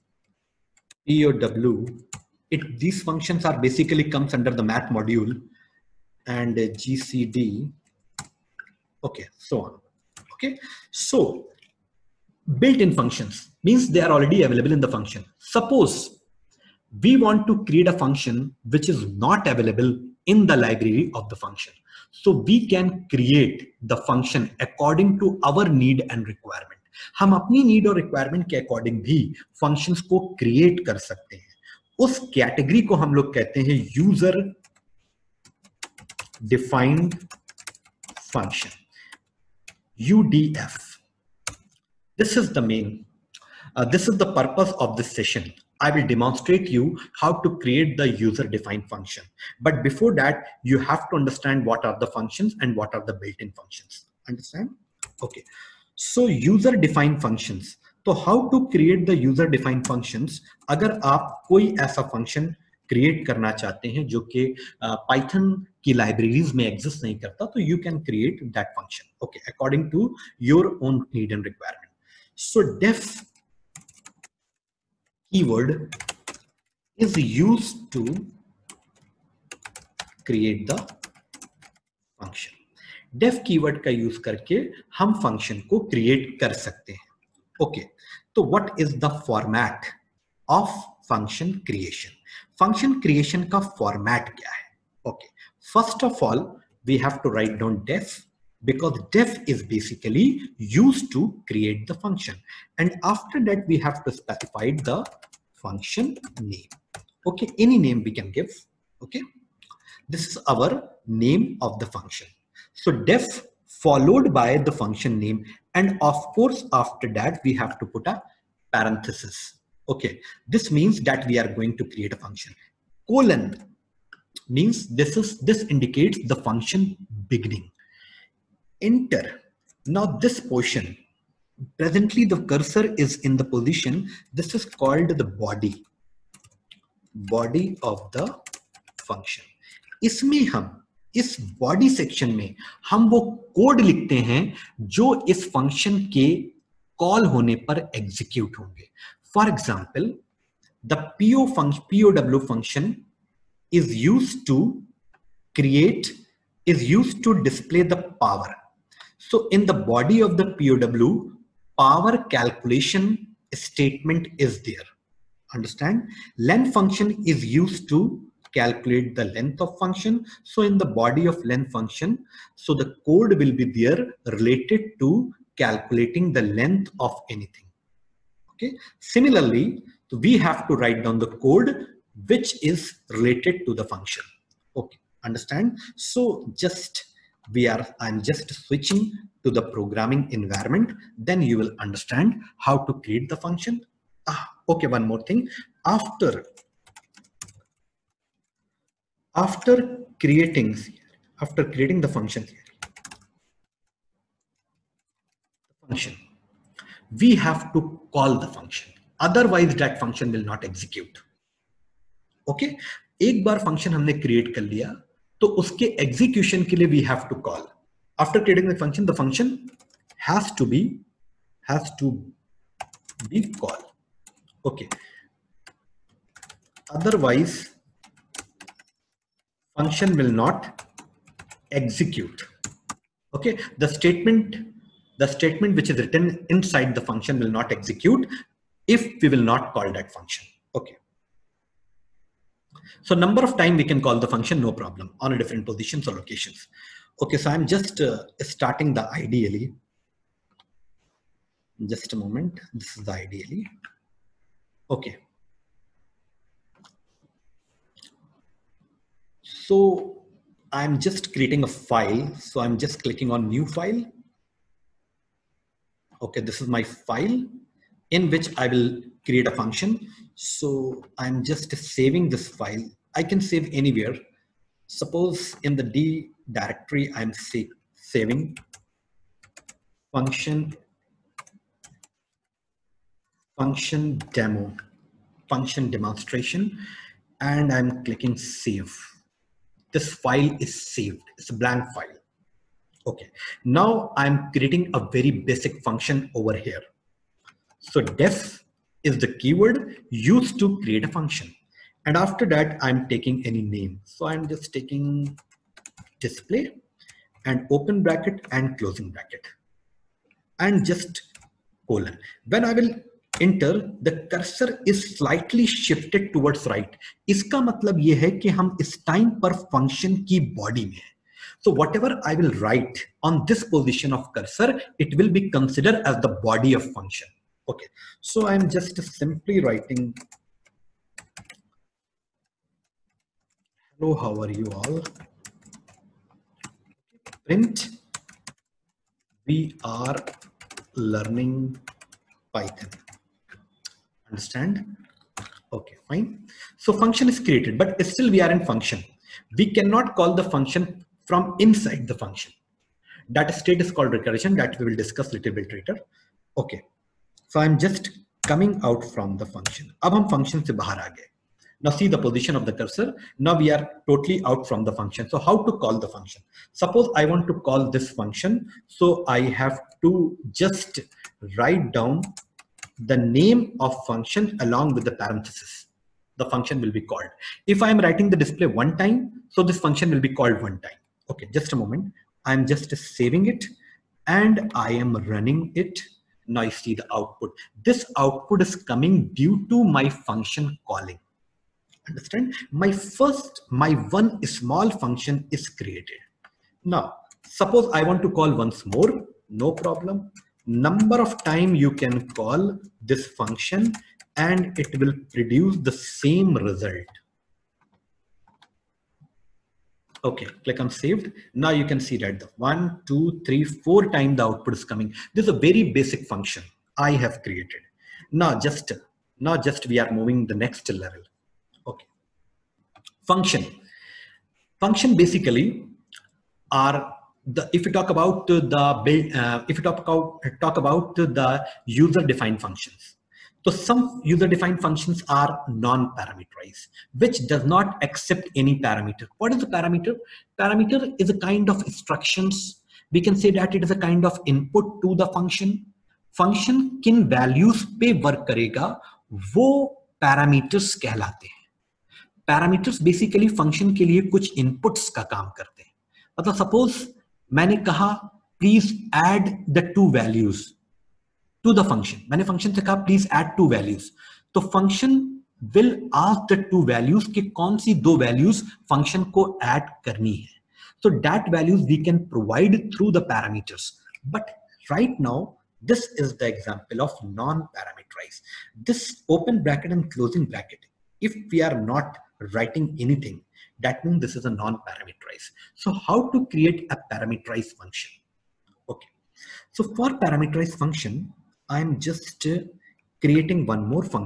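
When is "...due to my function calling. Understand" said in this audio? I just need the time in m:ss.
6:29.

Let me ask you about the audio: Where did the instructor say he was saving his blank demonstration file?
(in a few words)
D directory.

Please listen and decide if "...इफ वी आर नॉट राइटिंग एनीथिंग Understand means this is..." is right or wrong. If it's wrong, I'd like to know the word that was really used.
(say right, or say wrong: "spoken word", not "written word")
wrong: "That", not "Understand".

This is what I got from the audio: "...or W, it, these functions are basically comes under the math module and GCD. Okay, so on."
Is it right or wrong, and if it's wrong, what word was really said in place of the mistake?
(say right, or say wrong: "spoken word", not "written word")
right.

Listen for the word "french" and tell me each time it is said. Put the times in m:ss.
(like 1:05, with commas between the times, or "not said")
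not said.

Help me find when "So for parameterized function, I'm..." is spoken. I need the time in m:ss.
8:09.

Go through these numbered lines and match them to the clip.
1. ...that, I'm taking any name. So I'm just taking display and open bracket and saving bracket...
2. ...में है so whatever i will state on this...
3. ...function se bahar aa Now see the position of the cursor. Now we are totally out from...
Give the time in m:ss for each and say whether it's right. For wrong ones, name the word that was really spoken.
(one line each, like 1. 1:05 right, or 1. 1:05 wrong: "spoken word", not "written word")
1. 5:02 wrong: "closing", not "saving"
2. 5:20 wrong: "write", not "state"
3. 6:00 right.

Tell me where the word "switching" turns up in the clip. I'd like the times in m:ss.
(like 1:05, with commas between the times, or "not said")
3:08.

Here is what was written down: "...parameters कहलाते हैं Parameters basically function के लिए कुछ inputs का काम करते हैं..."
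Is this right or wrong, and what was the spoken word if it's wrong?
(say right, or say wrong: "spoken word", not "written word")
right.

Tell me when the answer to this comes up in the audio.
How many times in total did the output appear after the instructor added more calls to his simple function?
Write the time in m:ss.
6:53.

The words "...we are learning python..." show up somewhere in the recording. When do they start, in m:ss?
5:39.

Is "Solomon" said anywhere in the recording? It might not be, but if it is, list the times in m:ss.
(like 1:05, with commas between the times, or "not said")
not said.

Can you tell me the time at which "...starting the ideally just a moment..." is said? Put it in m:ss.
4:08.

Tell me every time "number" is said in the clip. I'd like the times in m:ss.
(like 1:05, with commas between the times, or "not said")
4:03, 6:40.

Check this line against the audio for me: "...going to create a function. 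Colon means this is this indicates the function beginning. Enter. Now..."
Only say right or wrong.
right.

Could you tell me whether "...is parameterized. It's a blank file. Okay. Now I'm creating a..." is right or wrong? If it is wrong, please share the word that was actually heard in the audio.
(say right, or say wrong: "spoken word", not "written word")
wrong: "saved", not "parameterized".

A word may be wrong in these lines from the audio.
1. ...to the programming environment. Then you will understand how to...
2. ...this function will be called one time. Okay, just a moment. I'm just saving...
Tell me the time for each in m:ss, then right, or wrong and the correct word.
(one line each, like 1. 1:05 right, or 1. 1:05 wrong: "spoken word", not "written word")
1. 3:09 right
2. 6:19 right.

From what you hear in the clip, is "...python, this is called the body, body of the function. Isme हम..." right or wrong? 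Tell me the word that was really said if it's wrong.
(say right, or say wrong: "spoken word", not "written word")
wrong: "position", not "python".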